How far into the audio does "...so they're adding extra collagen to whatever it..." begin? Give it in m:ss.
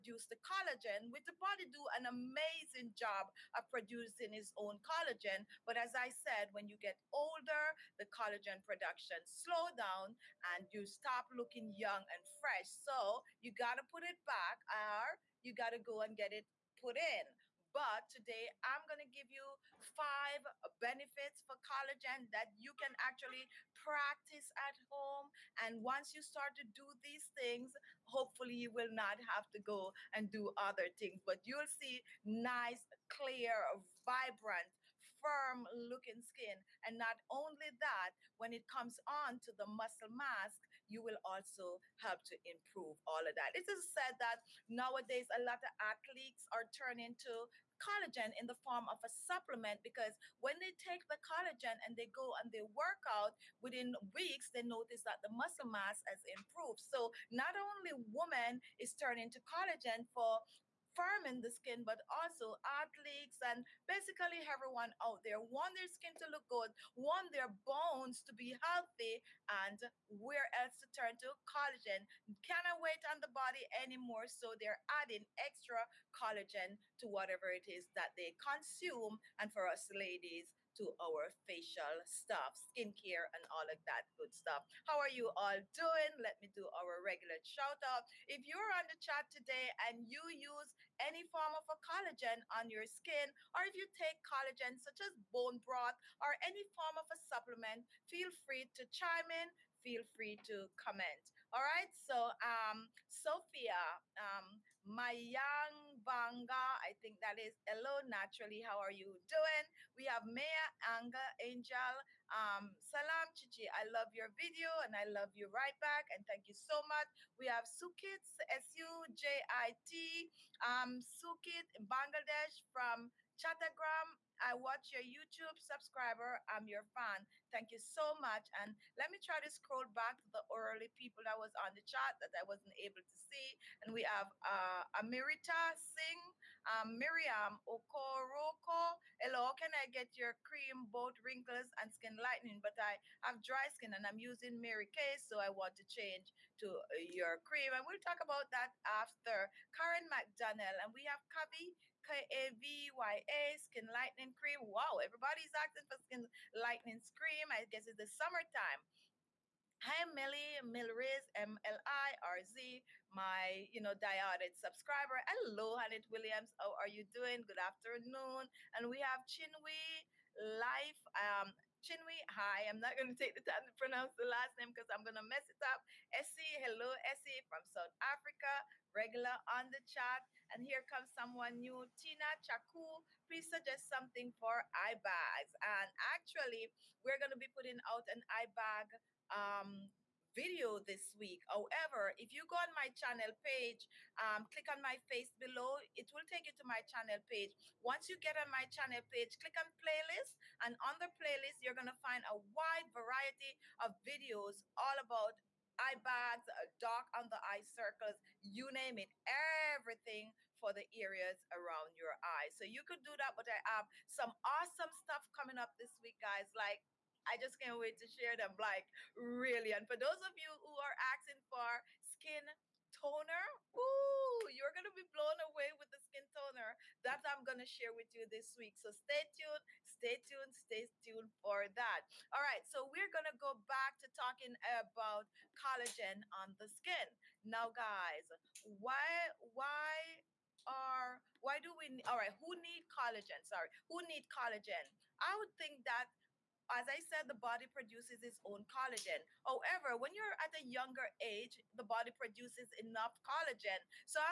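1:14.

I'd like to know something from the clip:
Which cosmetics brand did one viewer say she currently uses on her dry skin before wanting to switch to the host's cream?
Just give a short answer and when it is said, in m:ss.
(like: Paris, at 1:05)
Mary Kay, at 2:24.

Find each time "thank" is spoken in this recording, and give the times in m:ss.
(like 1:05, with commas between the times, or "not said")
1:56, 2:07.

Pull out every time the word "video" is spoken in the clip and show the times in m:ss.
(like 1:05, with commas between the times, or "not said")
1:54, 3:10, 3:24.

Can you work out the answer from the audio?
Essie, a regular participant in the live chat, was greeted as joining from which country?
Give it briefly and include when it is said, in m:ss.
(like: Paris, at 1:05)
South Africa, at 2:57.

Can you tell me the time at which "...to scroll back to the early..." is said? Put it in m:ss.
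2:09.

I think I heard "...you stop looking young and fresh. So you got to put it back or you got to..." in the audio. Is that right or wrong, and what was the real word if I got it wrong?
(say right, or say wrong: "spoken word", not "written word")
right.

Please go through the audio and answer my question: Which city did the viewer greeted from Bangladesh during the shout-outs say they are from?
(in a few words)
Chattagram.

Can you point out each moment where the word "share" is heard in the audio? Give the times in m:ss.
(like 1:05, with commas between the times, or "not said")
3:38, 3:47.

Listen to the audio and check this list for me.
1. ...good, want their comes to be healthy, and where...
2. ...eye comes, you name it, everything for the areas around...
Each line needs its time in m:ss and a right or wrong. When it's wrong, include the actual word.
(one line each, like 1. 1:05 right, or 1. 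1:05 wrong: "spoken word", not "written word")
1. 1:06 wrong: "bones", not "comes"
2. 3:27 wrong: "circles", not "comes".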